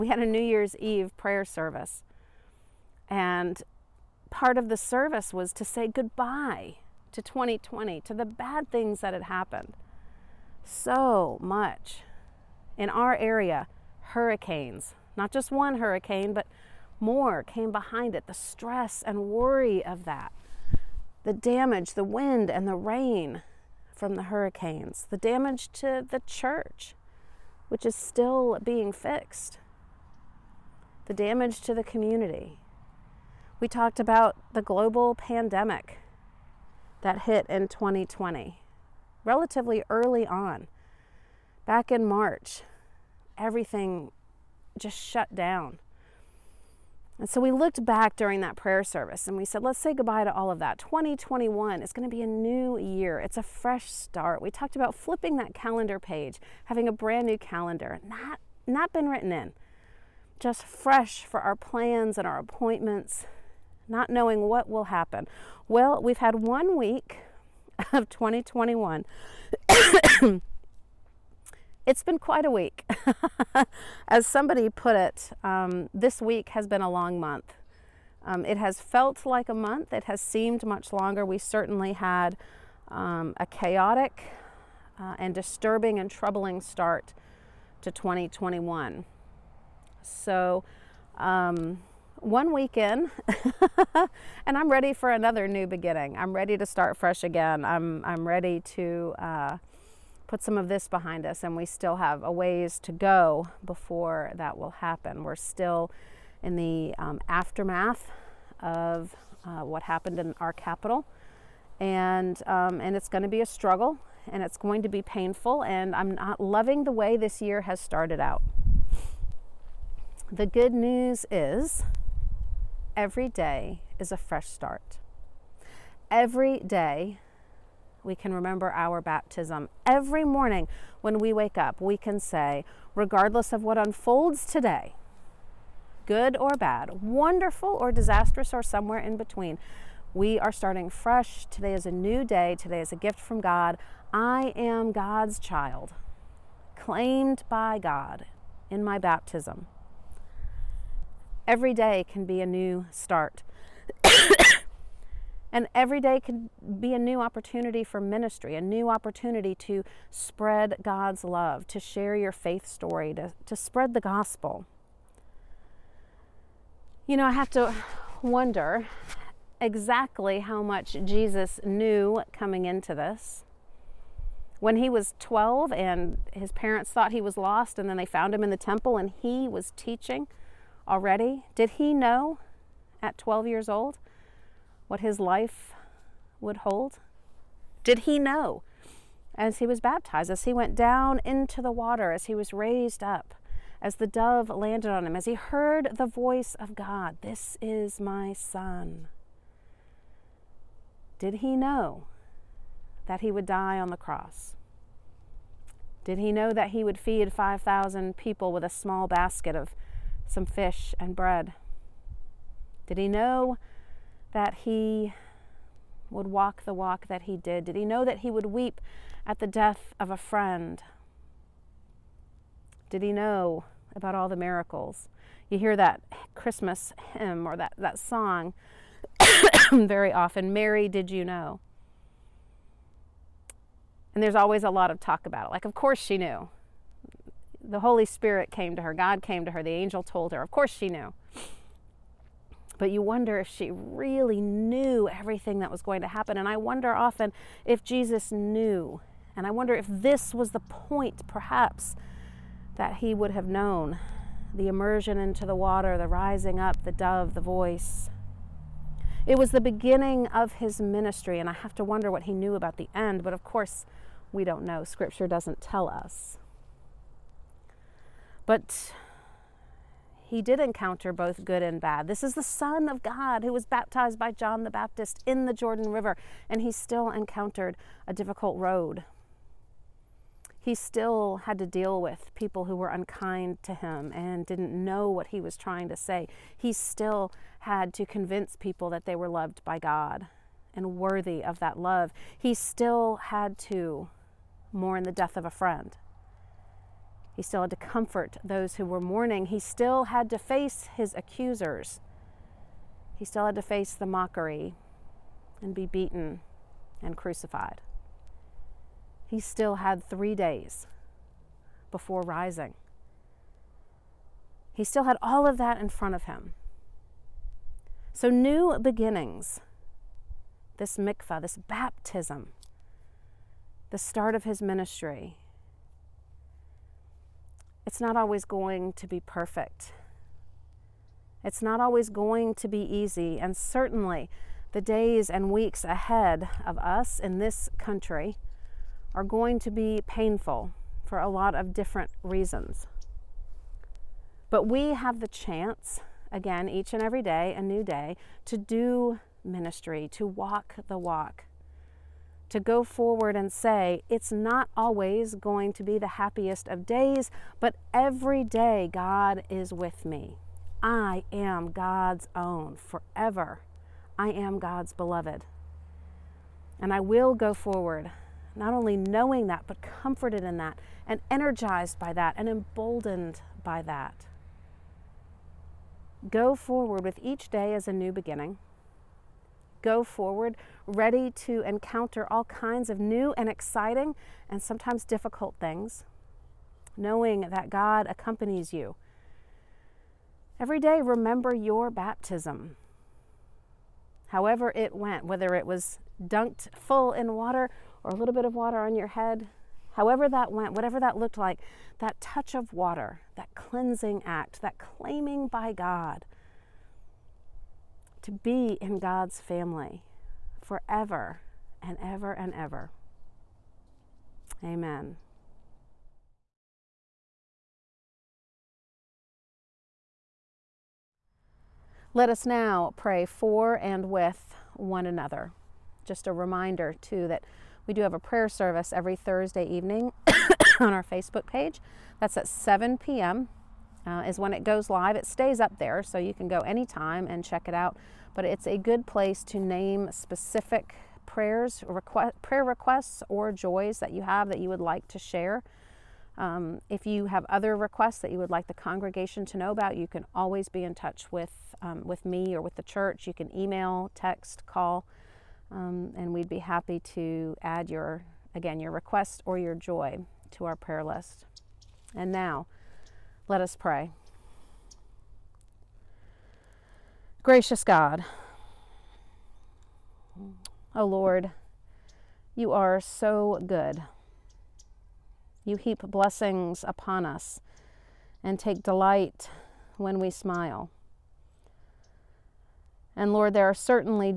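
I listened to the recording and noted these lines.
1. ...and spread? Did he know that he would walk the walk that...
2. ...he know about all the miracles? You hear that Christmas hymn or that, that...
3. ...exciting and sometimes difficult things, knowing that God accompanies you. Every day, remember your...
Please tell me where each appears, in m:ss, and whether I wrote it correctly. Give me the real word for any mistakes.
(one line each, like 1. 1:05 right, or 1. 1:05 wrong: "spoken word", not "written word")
1. 3:30 wrong: "bread", not "spread"
2. 3:43 right
3. 6:23 right.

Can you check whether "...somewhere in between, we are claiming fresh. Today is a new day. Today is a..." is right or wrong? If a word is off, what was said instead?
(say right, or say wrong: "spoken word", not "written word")
wrong: "starting", not "claiming".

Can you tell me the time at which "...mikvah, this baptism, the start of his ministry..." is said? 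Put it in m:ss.
5:20.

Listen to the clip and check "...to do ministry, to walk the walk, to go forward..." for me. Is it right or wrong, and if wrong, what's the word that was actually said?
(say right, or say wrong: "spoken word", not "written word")
right.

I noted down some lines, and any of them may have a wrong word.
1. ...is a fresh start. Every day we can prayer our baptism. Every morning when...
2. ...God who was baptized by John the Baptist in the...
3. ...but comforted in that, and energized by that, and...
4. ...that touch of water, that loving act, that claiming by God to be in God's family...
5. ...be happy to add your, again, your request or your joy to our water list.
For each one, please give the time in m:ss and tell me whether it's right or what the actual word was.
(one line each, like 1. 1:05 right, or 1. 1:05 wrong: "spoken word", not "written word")
1. 2:03 wrong: "remember", not "prayer"
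2. 4:33 right
3. 6:09 right
4. 6:41 wrong: "cleansing", not "loving"
5. 7:36 wrong: "prayer", not "water".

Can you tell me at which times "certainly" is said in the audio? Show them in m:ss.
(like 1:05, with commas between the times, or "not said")
1:21, 5:33, 8:03.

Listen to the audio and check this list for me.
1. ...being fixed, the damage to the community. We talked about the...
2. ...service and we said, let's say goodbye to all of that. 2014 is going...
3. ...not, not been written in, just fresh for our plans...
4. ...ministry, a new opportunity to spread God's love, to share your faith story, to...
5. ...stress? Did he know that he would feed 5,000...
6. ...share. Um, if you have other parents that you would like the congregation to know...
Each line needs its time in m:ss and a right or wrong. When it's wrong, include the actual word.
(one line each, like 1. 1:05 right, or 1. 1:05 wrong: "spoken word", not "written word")
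1. 0:28 right
2. 0:48 wrong: "2021", not "2014"
3. 0:58 right
4. 2:38 right
5. 3:23 wrong: "cross", not "stress"
6. 7:25 wrong: "requests", not "parents".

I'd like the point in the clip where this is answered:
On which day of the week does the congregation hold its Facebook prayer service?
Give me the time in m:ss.
7:09.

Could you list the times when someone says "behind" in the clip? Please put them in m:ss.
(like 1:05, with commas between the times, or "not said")
0:17, 1:40.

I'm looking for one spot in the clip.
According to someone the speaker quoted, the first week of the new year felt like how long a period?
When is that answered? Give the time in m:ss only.
1:16.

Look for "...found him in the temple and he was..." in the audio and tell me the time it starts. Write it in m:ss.
2:58.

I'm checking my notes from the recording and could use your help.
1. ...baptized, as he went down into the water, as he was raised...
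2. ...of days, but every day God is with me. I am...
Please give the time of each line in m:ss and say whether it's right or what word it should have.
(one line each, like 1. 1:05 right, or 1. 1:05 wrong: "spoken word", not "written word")
1. 3:09 right
2. 5:56 right.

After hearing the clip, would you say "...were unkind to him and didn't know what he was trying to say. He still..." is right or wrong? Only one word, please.
right.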